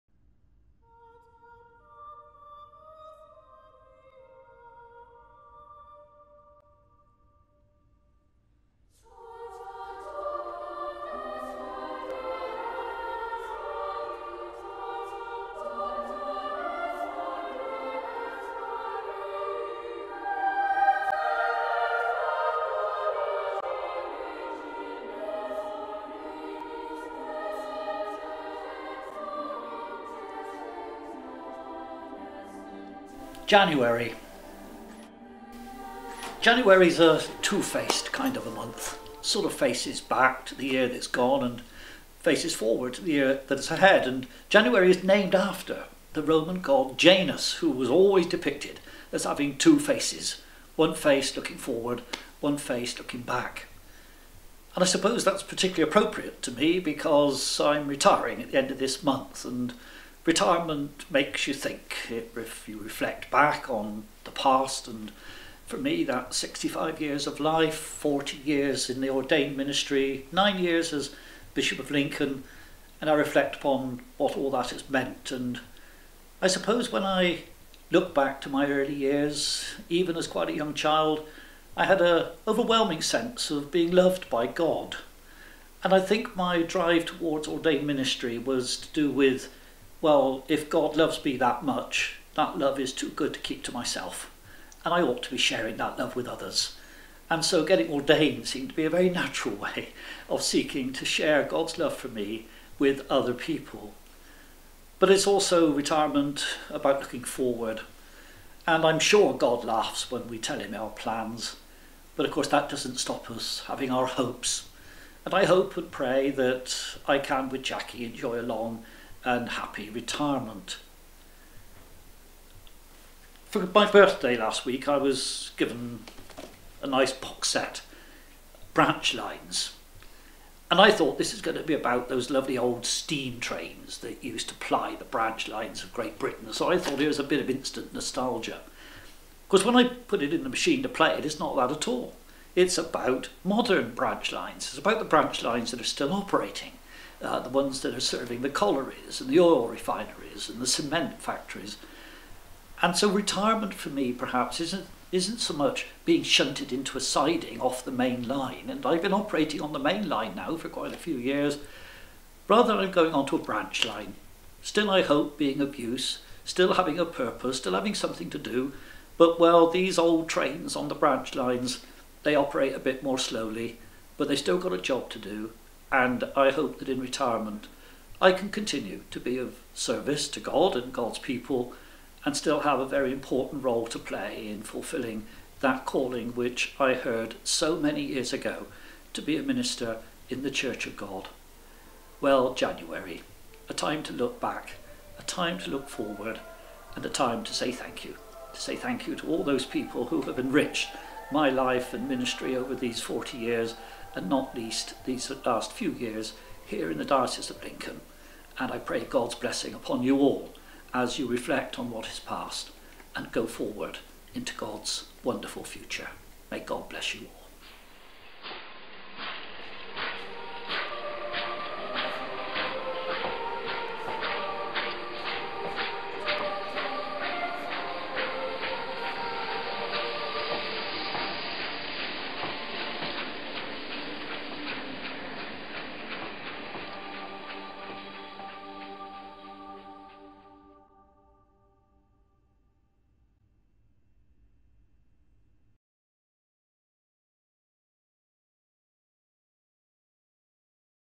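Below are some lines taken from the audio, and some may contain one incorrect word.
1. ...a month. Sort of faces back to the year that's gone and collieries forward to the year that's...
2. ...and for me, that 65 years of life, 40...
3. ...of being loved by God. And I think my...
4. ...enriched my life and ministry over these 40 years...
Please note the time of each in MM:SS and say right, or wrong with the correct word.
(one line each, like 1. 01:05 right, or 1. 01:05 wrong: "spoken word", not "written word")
1. 00:38 wrong: "faces", not "collieries"
2. 01:04 right
3. 01:23 right
4. 03:20 right.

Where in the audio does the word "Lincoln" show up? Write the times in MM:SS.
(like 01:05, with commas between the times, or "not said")
01:11, 03:27.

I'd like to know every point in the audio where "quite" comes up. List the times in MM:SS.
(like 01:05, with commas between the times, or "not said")
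01:20, 02:40.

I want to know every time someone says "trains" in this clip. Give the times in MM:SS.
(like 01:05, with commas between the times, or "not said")
02:13, 02:50.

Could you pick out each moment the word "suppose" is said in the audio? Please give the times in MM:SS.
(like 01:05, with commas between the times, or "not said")
00:54, 01:16.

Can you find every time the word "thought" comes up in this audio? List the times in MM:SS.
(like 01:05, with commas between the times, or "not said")
02:10, 02:16.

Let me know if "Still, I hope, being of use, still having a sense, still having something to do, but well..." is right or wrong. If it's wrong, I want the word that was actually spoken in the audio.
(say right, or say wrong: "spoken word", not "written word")
wrong: "purpose", not "sense".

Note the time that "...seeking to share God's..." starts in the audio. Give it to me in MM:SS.
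01:40.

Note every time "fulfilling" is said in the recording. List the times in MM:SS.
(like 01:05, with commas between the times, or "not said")
03:04.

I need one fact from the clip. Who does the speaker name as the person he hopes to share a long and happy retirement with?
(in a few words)
Jackie.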